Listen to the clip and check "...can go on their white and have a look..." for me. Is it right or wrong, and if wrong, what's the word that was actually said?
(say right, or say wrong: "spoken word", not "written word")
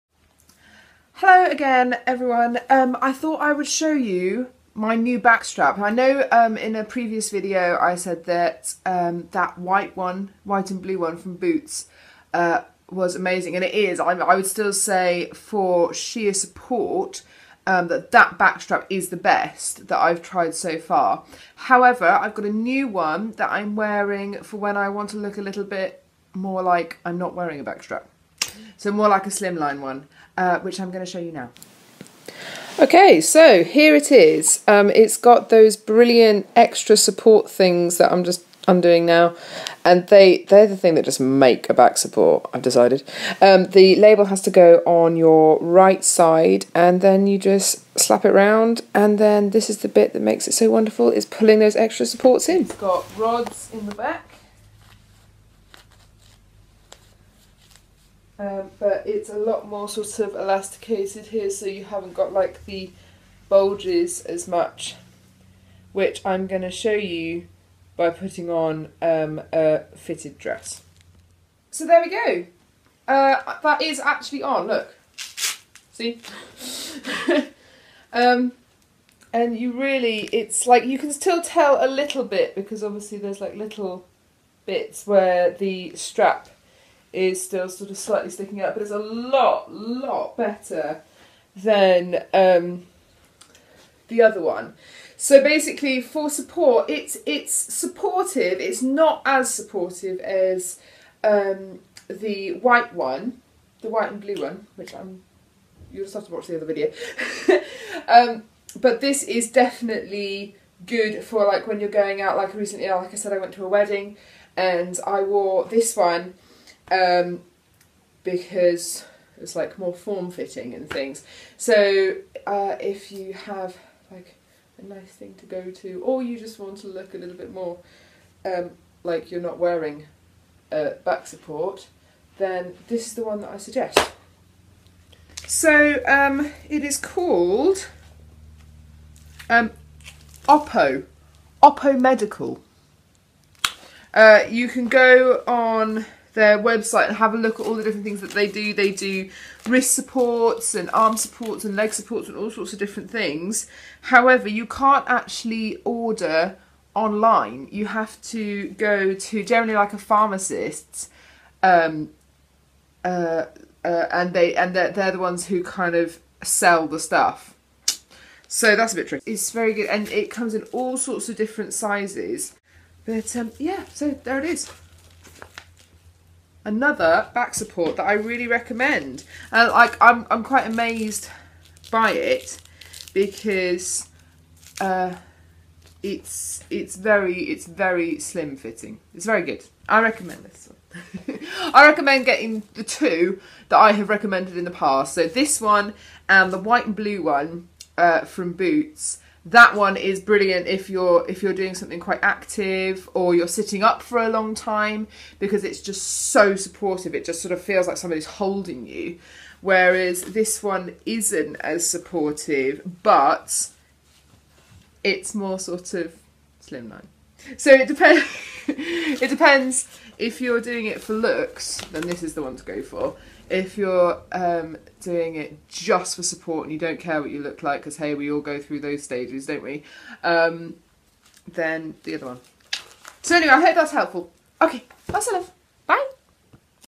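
wrong: "website", not "white".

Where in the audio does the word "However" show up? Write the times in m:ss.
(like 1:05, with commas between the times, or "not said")
0:21, 2:34.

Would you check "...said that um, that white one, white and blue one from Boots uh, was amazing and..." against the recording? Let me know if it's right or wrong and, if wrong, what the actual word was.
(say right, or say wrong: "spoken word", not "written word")
right.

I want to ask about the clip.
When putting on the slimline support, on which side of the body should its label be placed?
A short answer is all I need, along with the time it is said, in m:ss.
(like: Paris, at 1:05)
Right side, at 0:45.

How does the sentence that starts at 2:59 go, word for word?
Uh, like I'm, I'm quite amazed by it because uh, it's it's very it's very slim fitting.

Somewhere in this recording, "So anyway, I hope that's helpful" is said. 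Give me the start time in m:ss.
3:53.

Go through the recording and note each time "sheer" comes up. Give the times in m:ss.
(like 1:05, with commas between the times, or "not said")
0:15.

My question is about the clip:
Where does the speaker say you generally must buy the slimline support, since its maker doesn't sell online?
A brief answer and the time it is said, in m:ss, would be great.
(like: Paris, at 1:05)
A pharmacist, at 2:39.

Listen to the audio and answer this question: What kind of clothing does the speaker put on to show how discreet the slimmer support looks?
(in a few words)
A fitted dress.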